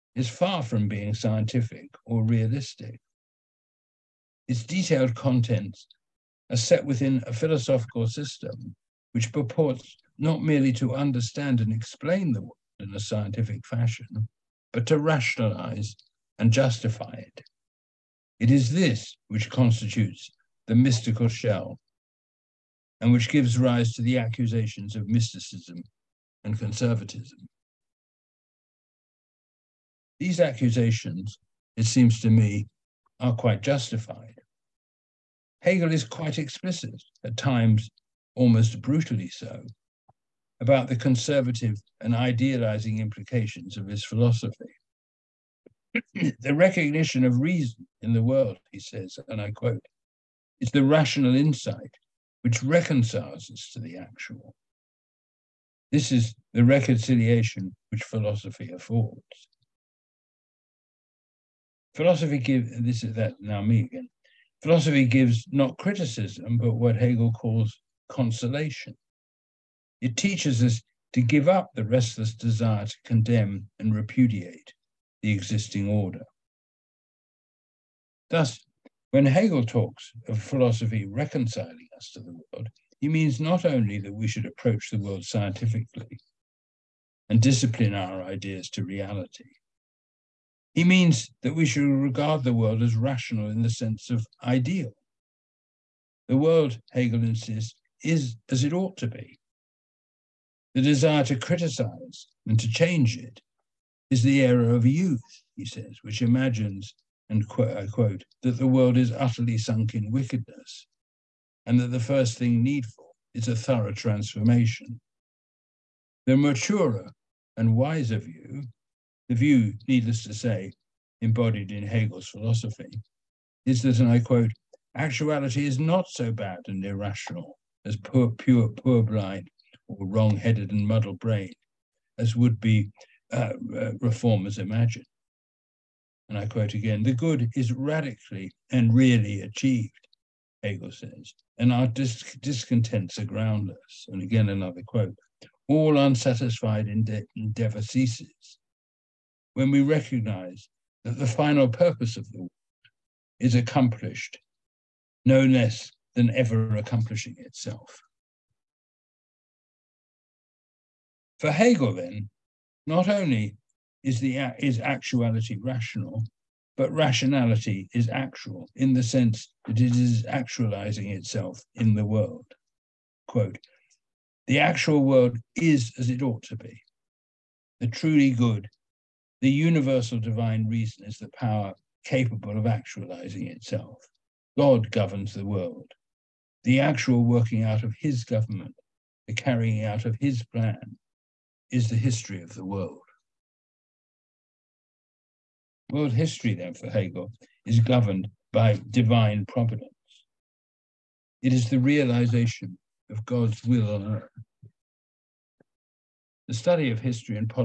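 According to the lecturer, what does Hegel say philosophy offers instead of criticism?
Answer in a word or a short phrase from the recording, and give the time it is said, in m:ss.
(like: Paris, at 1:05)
Consolation, at 1:08.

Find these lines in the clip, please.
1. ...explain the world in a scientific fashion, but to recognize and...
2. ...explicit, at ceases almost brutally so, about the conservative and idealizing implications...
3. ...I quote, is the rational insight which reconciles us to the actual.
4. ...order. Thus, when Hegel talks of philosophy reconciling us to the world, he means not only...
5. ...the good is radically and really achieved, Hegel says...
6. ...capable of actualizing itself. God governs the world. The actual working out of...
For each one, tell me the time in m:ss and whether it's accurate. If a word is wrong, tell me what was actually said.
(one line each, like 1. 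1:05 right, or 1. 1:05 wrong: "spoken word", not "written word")
1. 0:11 wrong: "rationalize", not "recognize"
2. 0:36 wrong: "times", not "ceases"
3. 0:49 right
4. 1:15 right
5. 2:17 right
6. 3:02 right.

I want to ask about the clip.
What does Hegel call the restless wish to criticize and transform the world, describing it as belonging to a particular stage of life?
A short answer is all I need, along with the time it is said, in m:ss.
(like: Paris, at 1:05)
The era of youth, at 1:44.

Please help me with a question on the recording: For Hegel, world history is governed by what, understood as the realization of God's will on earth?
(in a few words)
Divine providence.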